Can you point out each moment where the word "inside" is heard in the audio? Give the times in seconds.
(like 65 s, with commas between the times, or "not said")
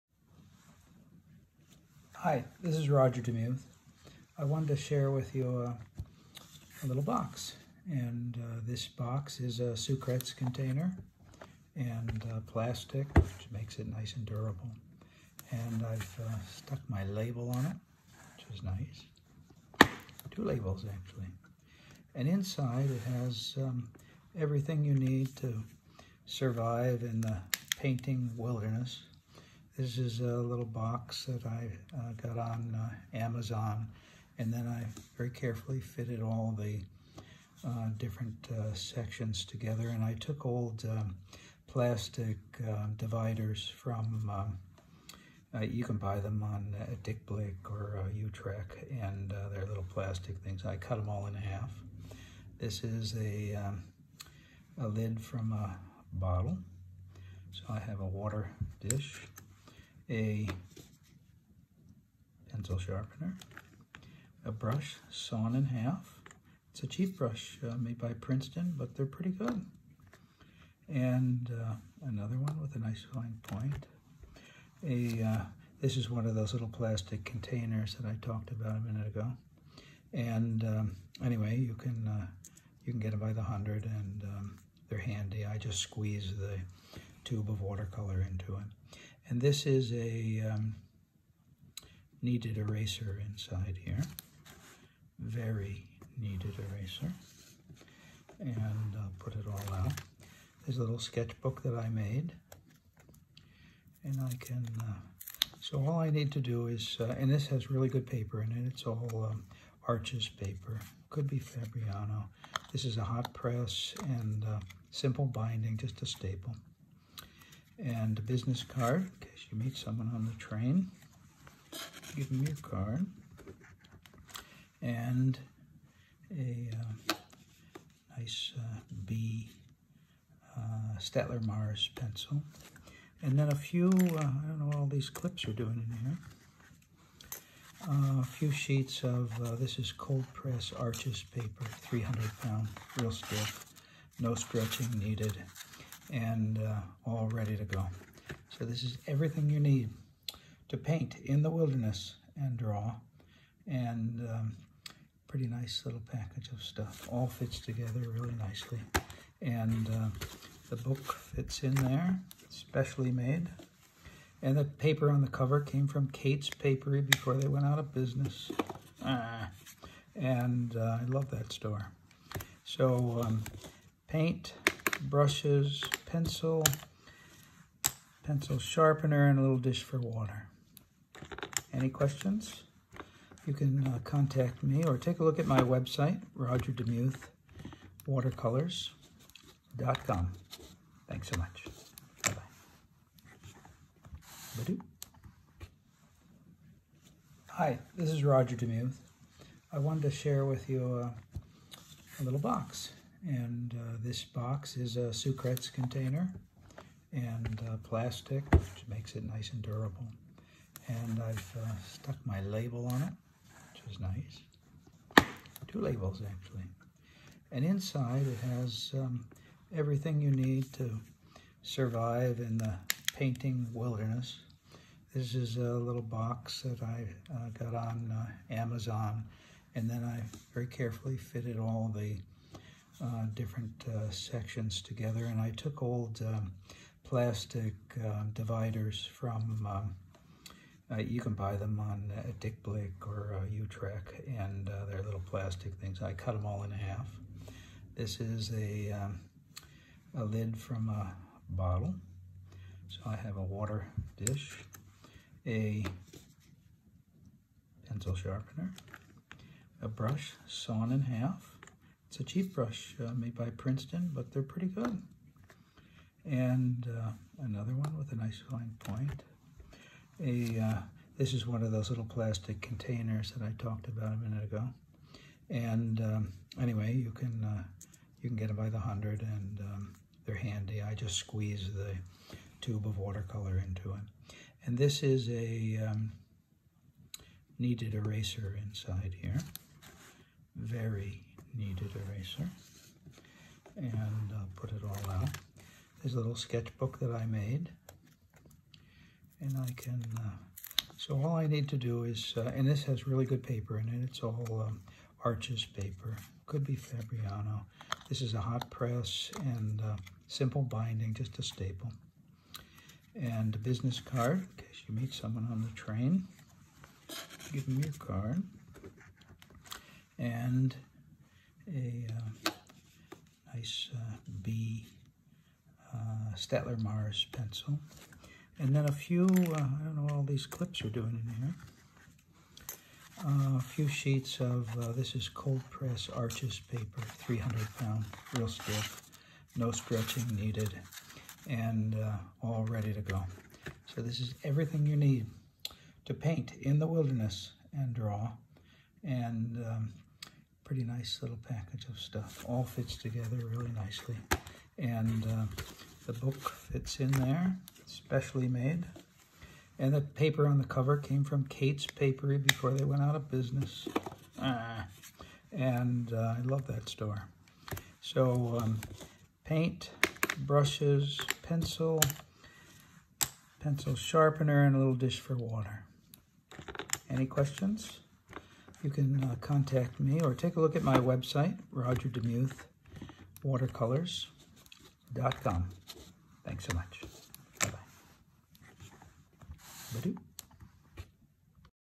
22 s, 93 s, 217 s, 288 s.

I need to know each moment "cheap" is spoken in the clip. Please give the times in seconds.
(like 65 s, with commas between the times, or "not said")
66 s, 262 s.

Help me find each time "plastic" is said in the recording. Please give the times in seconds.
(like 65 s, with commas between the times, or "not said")
12 s, 41 s, 49 s, 76 s, 207 s, 237 s, 245 s, 272 s.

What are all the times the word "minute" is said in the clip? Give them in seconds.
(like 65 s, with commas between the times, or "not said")
78 s, 274 s.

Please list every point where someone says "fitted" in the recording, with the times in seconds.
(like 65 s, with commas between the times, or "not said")
35 s, 231 s.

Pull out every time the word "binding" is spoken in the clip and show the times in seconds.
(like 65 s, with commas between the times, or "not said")
115 s, 310 s.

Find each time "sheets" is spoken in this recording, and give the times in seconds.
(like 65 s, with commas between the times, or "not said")
138 s, 333 s.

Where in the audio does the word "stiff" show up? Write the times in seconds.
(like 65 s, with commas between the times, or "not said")
143 s, 338 s.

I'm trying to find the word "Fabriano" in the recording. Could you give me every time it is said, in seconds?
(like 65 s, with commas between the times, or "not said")
111 s, 306 s.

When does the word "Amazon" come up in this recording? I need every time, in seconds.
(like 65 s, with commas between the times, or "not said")
33 s, 228 s.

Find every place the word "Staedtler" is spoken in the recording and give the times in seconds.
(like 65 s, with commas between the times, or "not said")
130 s, 326 s.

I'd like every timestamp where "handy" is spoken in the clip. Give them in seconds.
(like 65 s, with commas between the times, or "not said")
84 s, 280 s.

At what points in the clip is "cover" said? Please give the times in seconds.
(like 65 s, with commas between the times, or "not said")
165 s, 360 s.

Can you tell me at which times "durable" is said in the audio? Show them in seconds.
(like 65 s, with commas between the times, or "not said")
14 s, 209 s.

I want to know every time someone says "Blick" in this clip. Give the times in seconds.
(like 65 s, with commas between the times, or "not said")
47 s, 242 s.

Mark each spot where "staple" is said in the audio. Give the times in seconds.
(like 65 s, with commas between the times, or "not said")
116 s, 311 s.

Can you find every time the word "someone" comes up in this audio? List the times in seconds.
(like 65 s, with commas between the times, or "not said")
119 s, 315 s.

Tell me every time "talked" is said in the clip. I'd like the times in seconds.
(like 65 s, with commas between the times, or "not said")
78 s, 273 s.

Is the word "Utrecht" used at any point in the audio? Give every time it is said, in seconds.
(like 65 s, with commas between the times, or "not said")
48 s, 243 s.